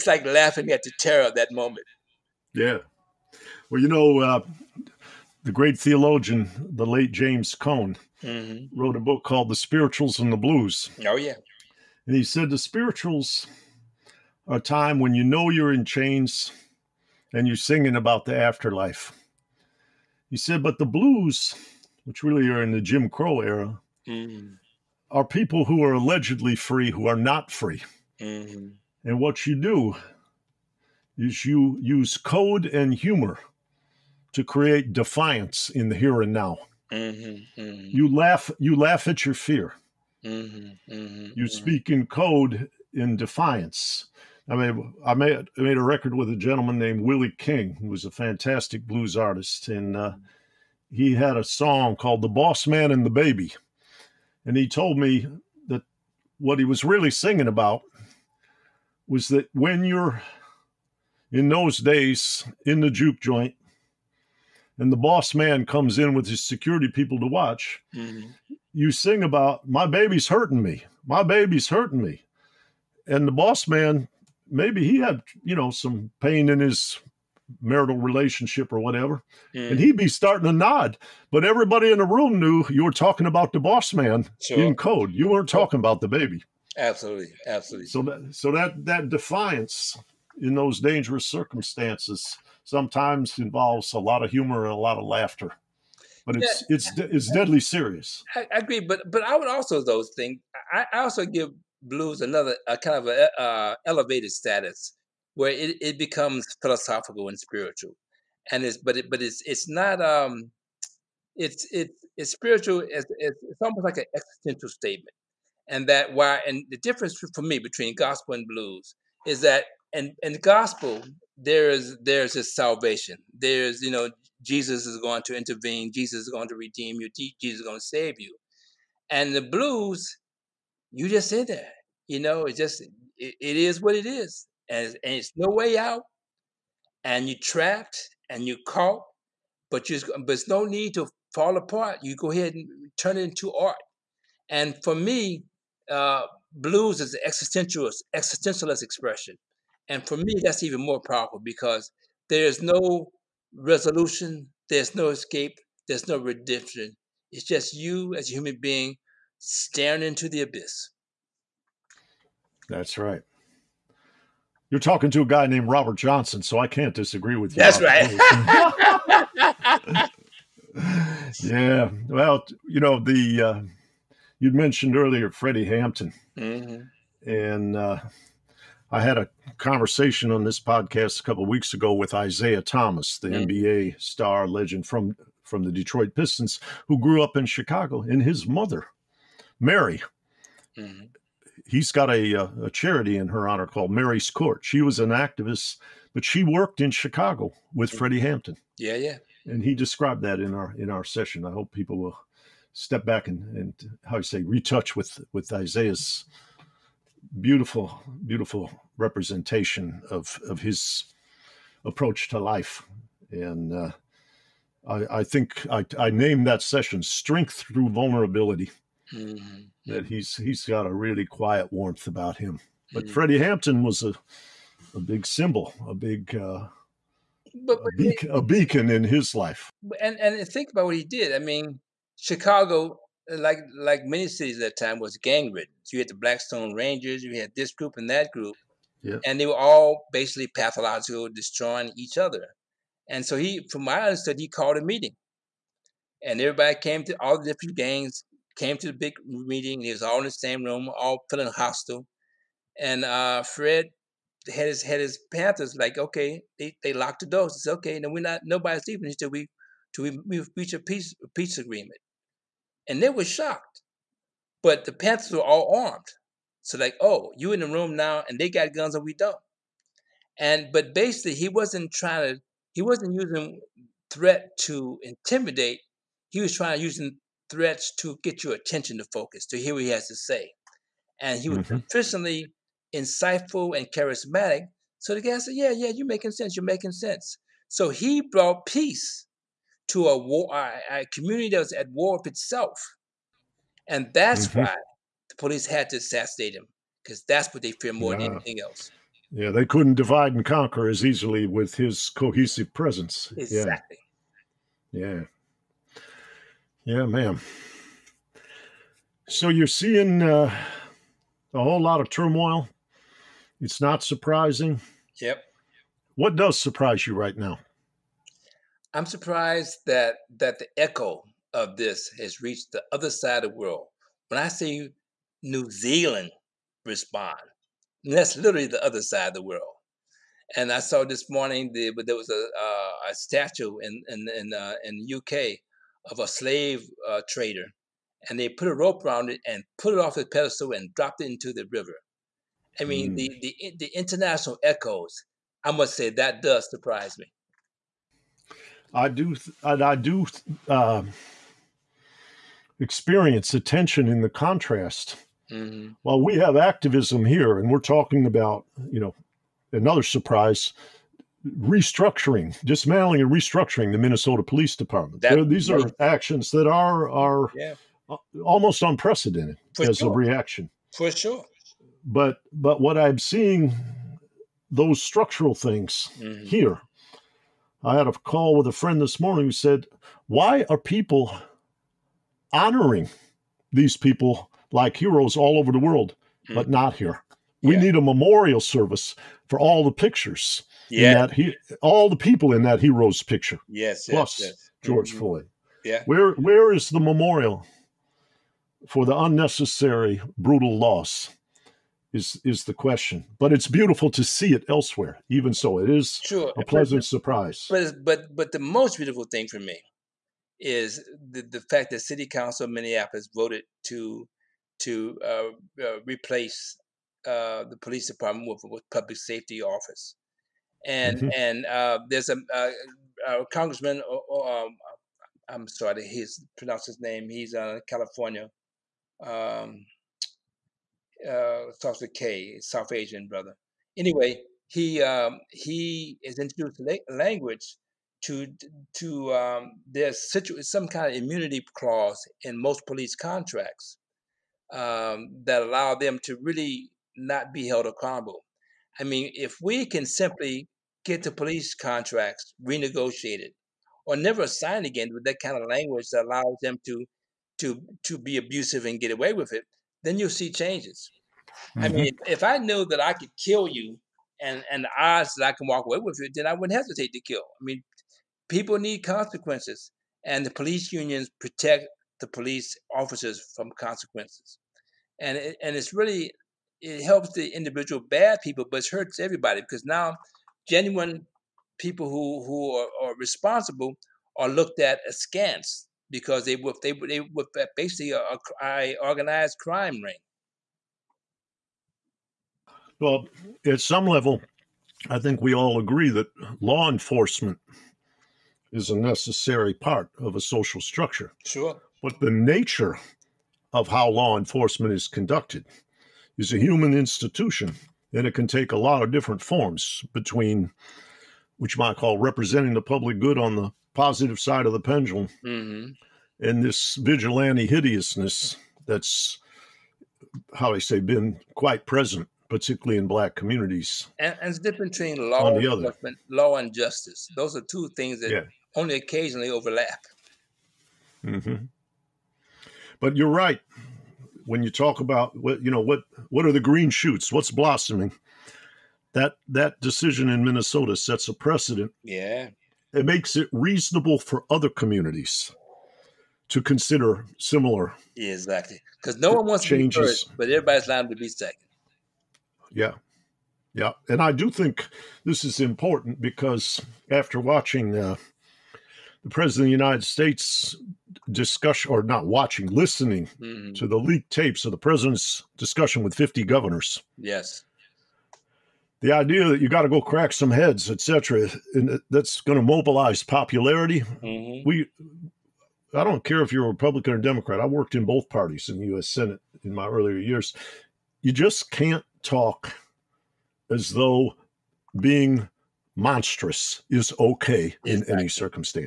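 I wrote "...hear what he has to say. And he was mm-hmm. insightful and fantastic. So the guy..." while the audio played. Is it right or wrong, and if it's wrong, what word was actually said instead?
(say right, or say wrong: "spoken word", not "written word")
wrong: "charismatic", not "fantastic".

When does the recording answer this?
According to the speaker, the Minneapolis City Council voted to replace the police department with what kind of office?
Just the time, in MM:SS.
06:58.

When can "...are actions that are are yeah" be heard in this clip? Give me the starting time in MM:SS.
06:05.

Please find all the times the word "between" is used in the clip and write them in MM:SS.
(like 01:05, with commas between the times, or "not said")
01:57, 08:30, 08:44.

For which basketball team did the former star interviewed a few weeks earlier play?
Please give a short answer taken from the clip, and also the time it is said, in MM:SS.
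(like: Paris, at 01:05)
Detroit Pistons, at 03:05.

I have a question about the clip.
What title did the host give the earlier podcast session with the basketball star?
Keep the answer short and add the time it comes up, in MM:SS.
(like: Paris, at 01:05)
strength through vulnerability, at 03:37.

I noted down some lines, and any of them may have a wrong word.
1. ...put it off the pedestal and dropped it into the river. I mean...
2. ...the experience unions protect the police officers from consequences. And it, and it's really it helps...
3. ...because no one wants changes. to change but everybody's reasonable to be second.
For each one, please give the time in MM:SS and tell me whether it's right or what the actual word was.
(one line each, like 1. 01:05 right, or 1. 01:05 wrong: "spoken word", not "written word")
1. 05:39 right
2. 07:50 wrong: "police", not "experience"
3. 09:08 wrong: "liable", not "reasonable".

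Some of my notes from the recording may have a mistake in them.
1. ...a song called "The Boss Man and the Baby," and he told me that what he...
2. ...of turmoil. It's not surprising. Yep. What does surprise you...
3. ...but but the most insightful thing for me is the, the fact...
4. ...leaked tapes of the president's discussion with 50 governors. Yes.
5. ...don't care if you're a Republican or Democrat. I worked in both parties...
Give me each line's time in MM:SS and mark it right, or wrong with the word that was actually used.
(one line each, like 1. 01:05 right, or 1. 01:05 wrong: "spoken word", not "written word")
1. 00:51 right
2. 05:12 right
3. 06:48 wrong: "beautiful", not "insightful"
4. 09:23 right
5. 09:36 right.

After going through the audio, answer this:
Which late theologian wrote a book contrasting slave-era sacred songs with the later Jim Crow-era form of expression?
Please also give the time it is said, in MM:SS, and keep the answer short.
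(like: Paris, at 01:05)
James Cone, at 00:07.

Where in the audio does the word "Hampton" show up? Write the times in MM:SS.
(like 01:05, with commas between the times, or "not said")
02:55, 03:18, 03:43.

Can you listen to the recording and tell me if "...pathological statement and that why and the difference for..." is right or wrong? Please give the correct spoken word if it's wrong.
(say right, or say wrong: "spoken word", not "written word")
wrong: "existential", not "pathological".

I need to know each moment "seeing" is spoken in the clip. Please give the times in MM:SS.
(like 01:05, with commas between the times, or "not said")
05:09, 06:13.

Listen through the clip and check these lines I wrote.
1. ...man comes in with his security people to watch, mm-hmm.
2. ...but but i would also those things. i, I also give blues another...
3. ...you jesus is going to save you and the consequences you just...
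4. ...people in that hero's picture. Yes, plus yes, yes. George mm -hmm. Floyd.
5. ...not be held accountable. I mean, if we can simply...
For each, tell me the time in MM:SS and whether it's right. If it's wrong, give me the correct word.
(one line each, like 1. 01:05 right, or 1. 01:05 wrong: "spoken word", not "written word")
1. 01:05 right
2. 01:38 right
3. 02:06 wrong: "blues", not "consequences"
4. 06:32 right
5. 07:27 right.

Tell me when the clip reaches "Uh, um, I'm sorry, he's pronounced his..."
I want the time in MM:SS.
07:04.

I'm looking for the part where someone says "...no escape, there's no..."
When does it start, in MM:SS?
02:34.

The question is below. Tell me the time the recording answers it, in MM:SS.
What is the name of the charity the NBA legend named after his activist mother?
03:13.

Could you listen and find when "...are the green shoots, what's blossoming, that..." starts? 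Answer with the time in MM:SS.
08:56.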